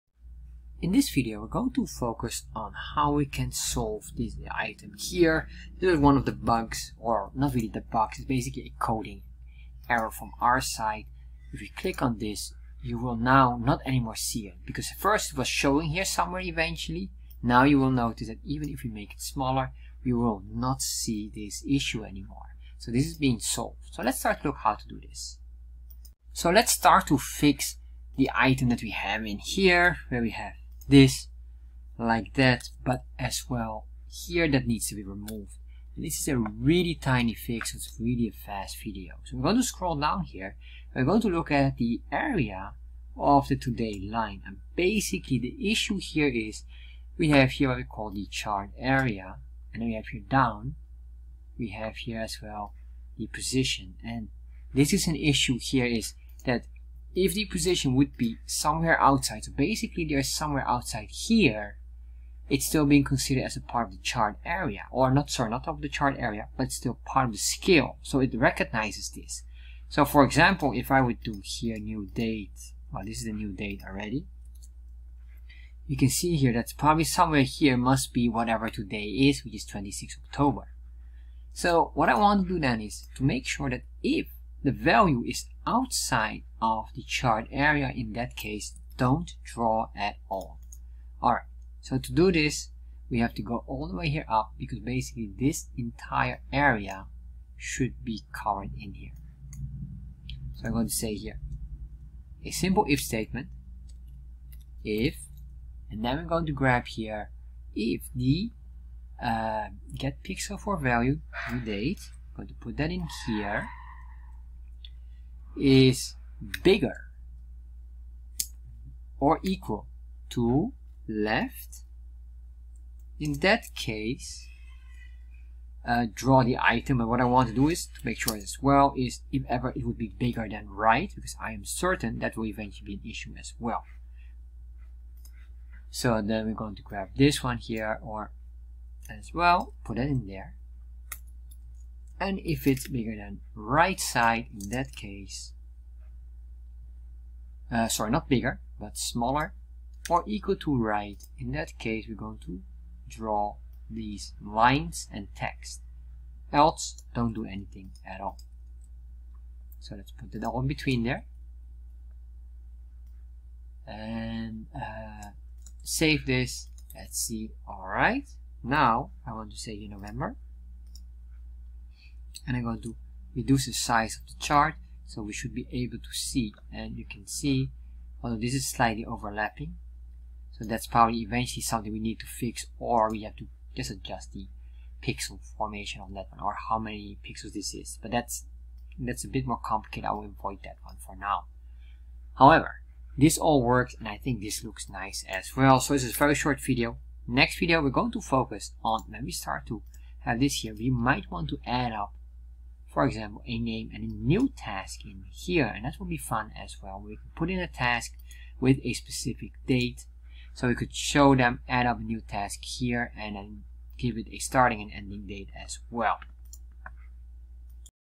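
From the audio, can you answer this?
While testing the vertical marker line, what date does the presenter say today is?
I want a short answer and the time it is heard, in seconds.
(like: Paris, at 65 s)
26 October, at 79 s.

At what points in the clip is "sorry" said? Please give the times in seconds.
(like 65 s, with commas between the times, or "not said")
65 s, 147 s.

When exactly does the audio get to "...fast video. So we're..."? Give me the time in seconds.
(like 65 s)
38 s.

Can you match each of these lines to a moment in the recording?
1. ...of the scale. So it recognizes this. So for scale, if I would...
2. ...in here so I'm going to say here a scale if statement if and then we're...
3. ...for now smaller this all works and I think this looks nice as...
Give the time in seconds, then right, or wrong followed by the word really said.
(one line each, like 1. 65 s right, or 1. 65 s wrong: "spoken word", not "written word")
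1. 67 s wrong: "example", not "scale"
2. 98 s wrong: "simple", not "scale"
3. 191 s wrong: "however", not "smaller".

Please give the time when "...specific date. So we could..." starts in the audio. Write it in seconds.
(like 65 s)
208 s.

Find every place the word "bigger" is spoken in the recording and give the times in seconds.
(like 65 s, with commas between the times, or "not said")
116 s, 130 s, 142 s, 148 s.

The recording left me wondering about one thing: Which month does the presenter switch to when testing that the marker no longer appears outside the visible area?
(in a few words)
November.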